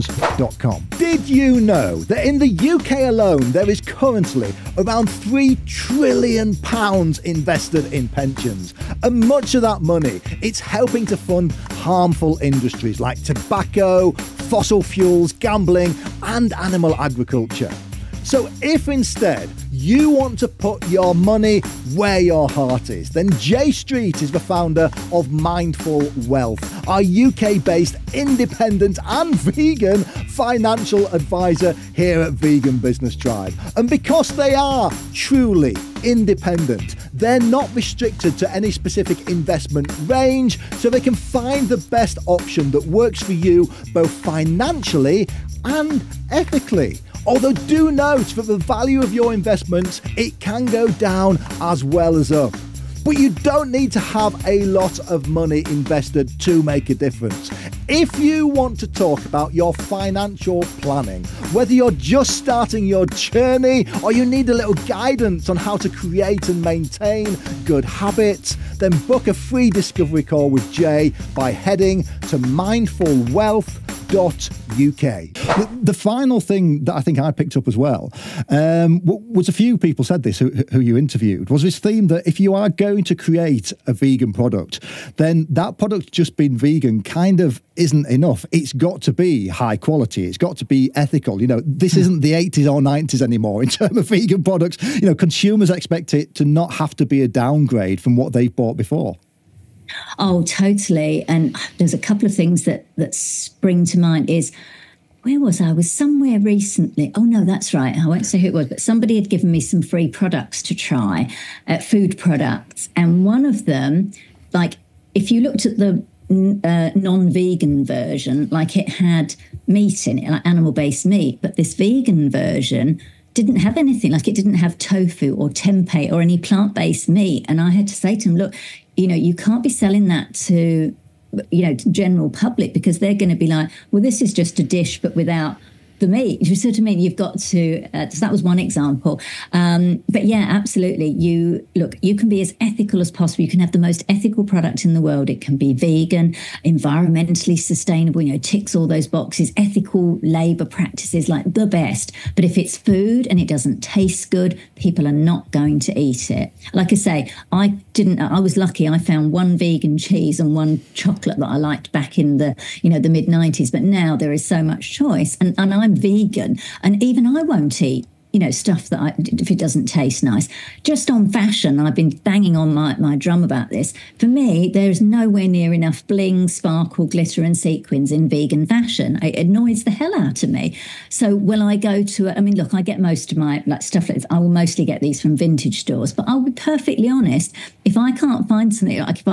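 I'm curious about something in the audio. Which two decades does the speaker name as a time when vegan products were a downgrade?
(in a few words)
80s or 90s.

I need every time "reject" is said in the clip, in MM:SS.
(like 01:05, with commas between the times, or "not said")
not said.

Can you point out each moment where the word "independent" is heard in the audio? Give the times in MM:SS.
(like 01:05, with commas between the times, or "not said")
00:28, 00:36.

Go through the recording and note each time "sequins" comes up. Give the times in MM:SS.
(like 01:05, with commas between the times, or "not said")
02:57.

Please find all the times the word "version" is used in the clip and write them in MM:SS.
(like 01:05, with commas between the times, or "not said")
01:57, 02:02.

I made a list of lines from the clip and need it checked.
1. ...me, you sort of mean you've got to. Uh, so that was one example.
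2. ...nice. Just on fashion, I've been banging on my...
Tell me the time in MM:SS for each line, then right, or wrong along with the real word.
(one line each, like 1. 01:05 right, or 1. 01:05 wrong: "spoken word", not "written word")
1. 02:16 right
2. 02:50 right.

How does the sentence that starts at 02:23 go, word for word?
You can have the most ethical product in the world.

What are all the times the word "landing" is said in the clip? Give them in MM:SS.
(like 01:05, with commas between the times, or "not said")
not said.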